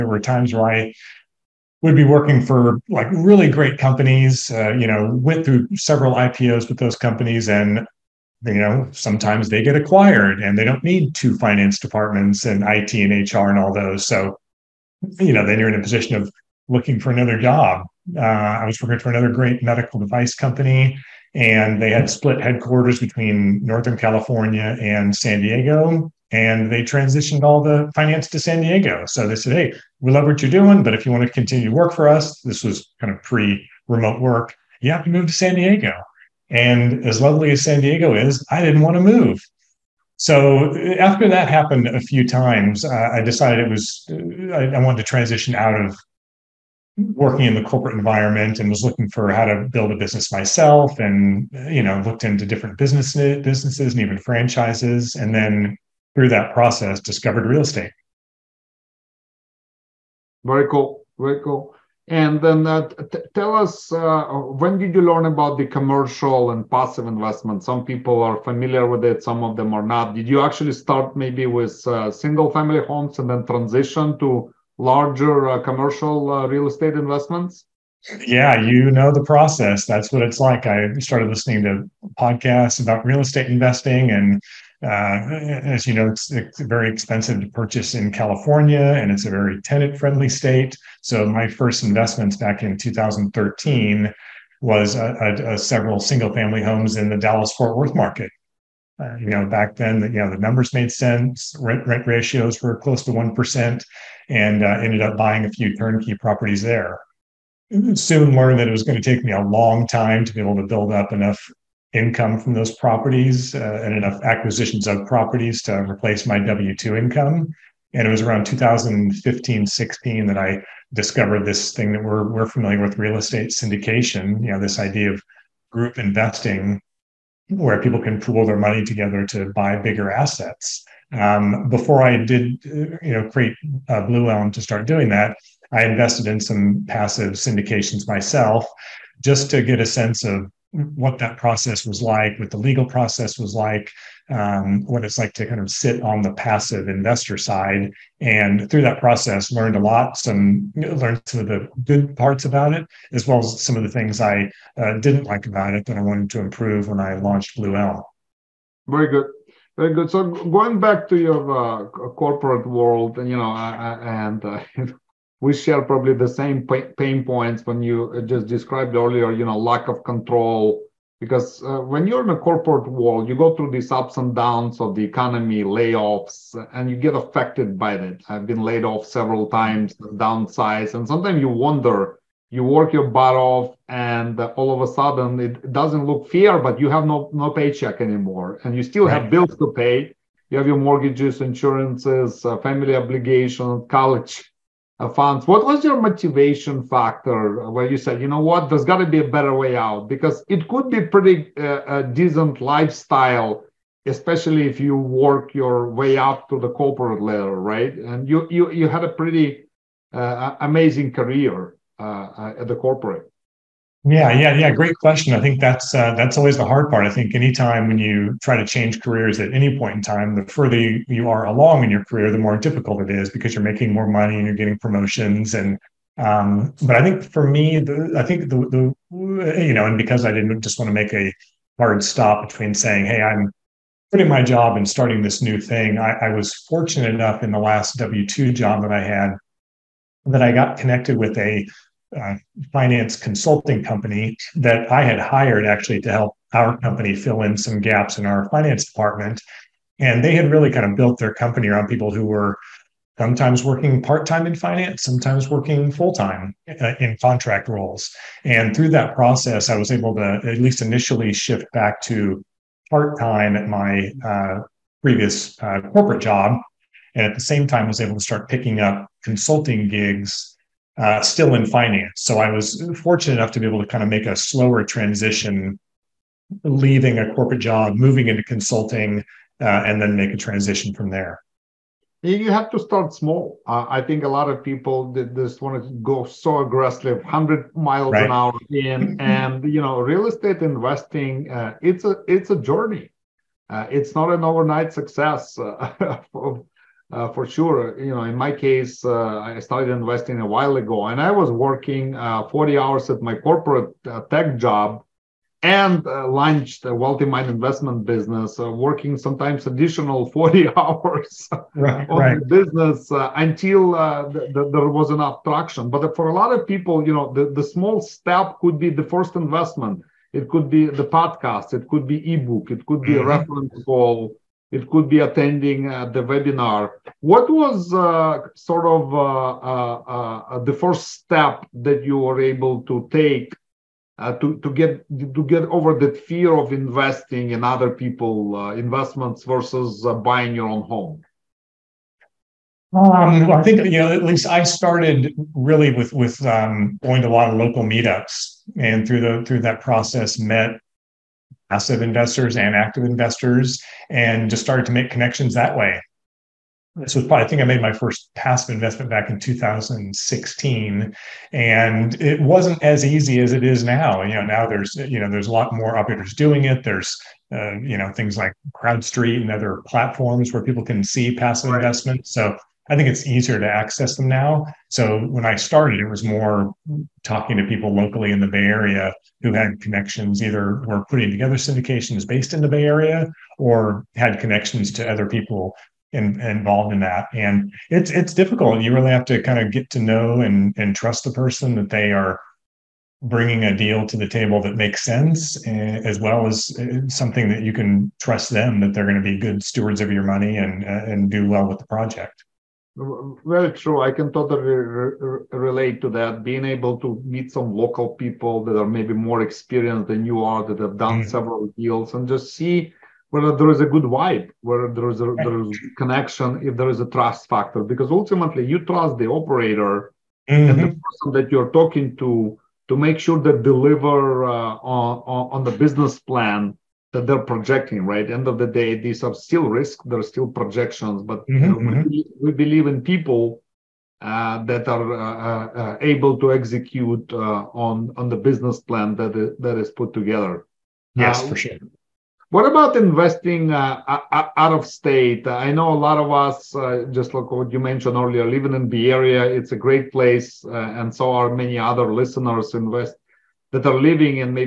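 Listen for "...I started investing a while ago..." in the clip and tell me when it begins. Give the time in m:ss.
4:59.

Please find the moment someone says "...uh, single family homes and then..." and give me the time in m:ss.
1:11.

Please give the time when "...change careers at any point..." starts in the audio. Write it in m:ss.
3:38.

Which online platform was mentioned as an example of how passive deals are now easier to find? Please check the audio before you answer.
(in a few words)
CrowdStreet.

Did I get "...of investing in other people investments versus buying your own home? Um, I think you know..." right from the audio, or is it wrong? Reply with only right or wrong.
right.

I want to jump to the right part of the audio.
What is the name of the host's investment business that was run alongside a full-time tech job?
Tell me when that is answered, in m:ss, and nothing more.
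5:06.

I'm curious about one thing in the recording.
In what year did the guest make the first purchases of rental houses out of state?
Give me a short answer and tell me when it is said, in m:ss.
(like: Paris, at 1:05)
2013, at 1:32.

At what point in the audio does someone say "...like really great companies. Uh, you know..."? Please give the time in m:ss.
0:02.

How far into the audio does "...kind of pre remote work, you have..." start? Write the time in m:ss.
0:32.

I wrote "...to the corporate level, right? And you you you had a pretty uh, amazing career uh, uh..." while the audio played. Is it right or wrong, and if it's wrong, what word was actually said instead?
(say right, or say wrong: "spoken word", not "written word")
right.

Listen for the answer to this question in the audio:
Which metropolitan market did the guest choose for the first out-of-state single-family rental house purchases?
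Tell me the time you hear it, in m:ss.
1:37.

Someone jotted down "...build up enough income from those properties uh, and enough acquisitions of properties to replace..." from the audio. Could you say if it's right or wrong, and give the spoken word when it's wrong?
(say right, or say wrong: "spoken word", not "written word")
right.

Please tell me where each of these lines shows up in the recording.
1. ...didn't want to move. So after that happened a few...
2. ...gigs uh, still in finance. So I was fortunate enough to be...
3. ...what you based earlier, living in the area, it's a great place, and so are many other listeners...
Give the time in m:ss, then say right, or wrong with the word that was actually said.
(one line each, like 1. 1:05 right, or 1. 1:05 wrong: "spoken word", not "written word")
1. 0:38 right
2. 4:29 right
3. 7:27 wrong: "mentioned", not "based".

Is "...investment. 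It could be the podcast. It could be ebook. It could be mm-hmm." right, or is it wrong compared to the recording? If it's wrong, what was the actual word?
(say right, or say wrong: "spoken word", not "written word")
right.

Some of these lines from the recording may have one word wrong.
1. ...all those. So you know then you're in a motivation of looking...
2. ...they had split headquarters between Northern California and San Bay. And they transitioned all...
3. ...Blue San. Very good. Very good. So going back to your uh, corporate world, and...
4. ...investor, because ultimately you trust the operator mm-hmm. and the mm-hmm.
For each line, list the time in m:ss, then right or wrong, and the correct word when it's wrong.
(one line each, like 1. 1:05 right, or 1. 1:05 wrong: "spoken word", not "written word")
1. 0:13 wrong: "position", not "motivation"
2. 0:21 wrong: "Diego", not "Bay"
3. 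2:37 wrong: "Elm", not "San"
4. 6:57 wrong: "factor", not "investor".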